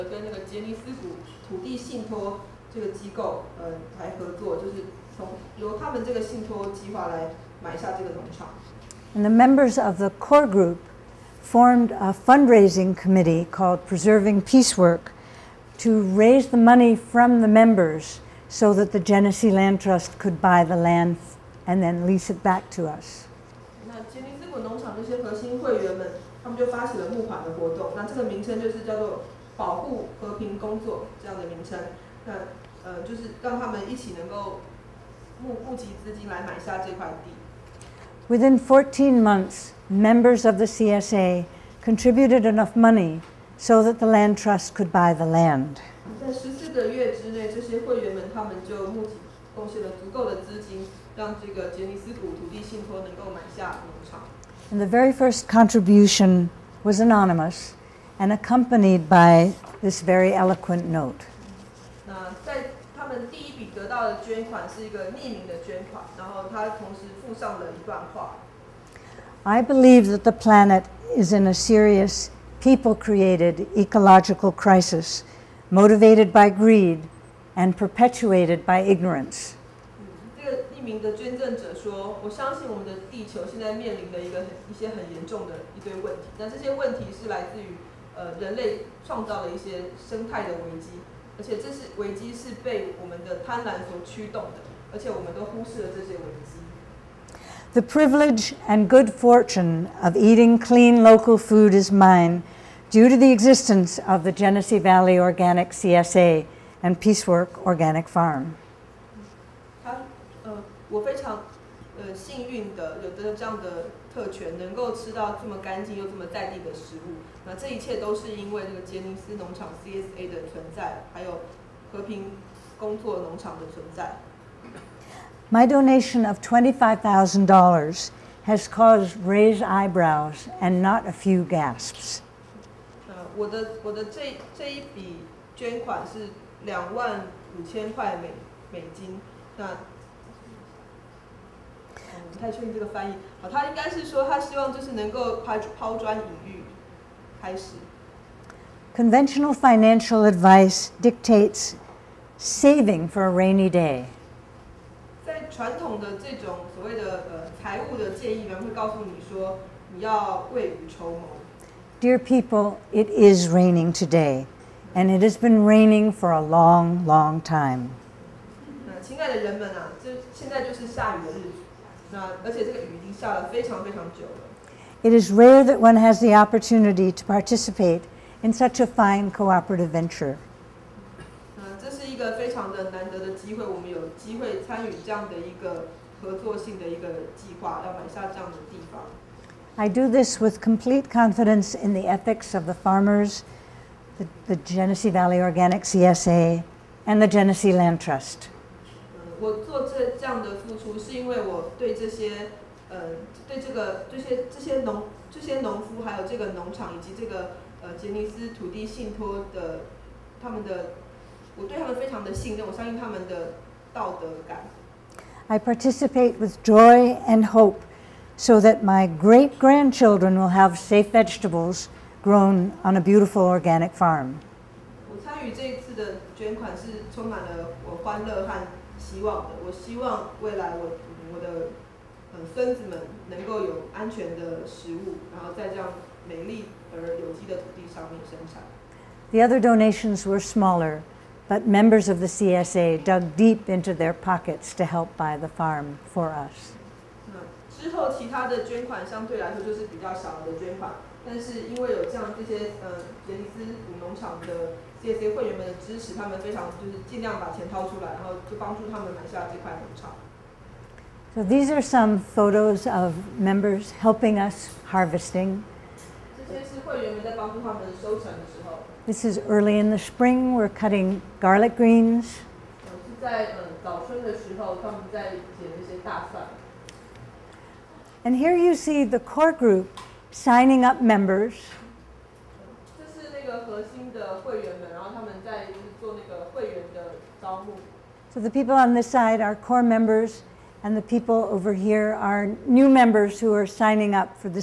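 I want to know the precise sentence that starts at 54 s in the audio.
And the very first contribution was anonymous and accompanied by this very eloquent note.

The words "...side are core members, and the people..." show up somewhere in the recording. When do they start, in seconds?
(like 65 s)
289 s.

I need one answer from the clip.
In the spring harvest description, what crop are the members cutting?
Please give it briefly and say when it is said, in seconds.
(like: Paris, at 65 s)
Garlic greens, at 271 s.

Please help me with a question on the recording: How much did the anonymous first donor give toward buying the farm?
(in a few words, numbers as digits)
$25,000.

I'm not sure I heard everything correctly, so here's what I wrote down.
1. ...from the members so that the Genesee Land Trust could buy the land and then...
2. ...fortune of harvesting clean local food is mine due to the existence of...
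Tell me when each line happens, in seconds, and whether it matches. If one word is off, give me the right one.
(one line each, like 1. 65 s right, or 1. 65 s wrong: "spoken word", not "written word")
1. 16 s right
2. 99 s wrong: "eating", not "harvesting".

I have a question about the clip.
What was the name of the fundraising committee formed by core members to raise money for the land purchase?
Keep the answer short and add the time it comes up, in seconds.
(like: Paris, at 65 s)
Preserving Peacework, at 13 s.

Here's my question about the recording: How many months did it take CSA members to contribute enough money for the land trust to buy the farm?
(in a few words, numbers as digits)
14.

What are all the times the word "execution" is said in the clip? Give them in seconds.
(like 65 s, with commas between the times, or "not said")
not said.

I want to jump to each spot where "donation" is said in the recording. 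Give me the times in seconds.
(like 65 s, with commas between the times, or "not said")
125 s, 239 s.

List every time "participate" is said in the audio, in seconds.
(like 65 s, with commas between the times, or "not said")
177 s, 215 s.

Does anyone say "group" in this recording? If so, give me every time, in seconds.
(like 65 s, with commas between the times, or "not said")
10 s, 279 s.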